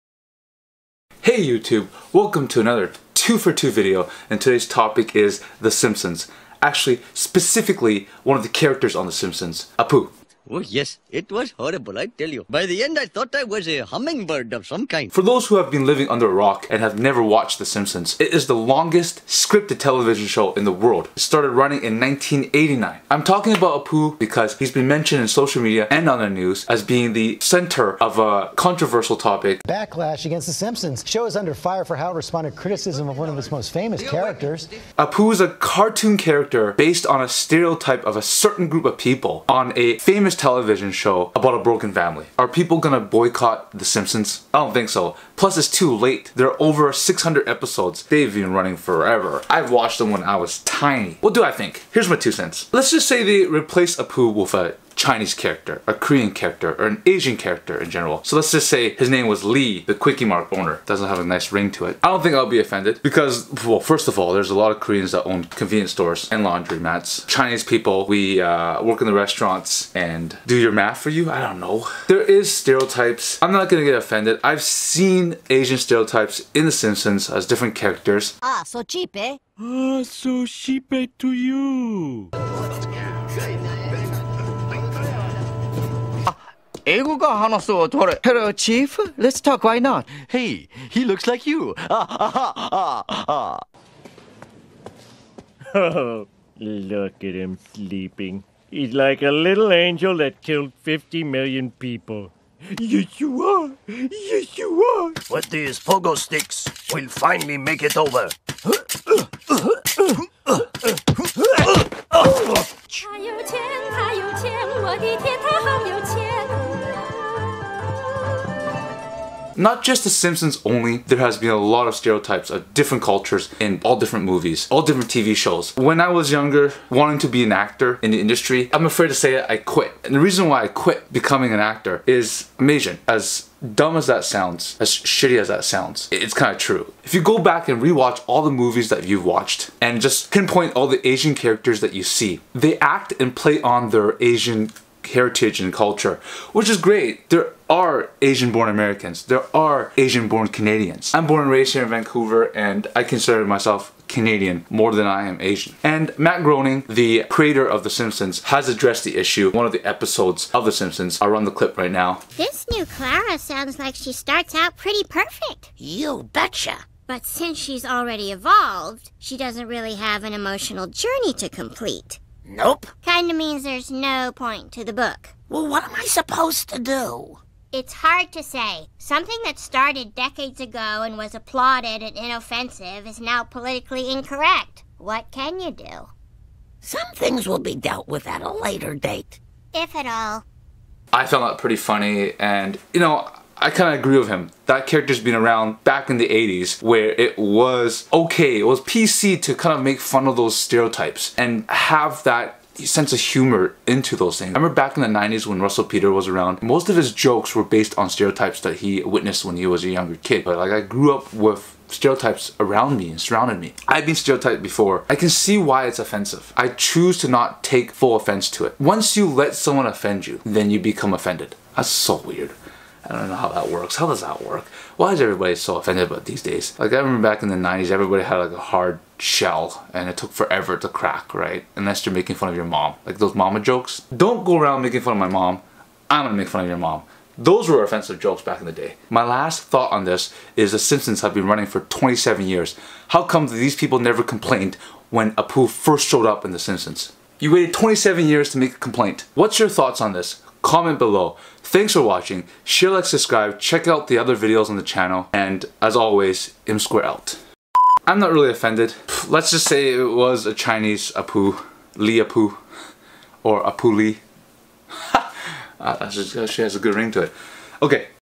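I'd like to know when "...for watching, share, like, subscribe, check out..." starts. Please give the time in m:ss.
4:11.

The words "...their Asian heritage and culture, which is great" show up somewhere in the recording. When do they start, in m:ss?
2:23.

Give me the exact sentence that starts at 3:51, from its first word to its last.
Unless you're making fun of your mom.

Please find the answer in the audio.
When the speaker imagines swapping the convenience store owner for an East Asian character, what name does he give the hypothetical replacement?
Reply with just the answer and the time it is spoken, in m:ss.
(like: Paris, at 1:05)
Lee, at 0:59.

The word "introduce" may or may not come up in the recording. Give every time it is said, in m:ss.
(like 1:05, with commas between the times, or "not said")
not said.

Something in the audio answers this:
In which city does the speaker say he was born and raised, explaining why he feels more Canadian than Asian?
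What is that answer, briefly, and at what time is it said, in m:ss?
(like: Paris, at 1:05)
Vancouver, at 2:31.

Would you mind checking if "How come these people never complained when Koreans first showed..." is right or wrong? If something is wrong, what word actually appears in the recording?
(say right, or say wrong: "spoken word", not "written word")
wrong: "Apu", not "Koreans".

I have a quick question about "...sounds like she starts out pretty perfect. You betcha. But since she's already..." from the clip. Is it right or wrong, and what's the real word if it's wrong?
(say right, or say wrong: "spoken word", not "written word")
right.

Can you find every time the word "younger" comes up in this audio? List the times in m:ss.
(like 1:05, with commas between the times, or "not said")
2:06, 3:29.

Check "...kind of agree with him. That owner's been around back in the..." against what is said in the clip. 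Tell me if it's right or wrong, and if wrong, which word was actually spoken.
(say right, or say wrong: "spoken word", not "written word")
wrong: "character", not "owner".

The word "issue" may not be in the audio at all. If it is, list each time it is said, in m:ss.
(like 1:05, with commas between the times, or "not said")
2:39.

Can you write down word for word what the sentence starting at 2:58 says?
Something that started decades ago and was applauded and inoffensive is now politically incorrect.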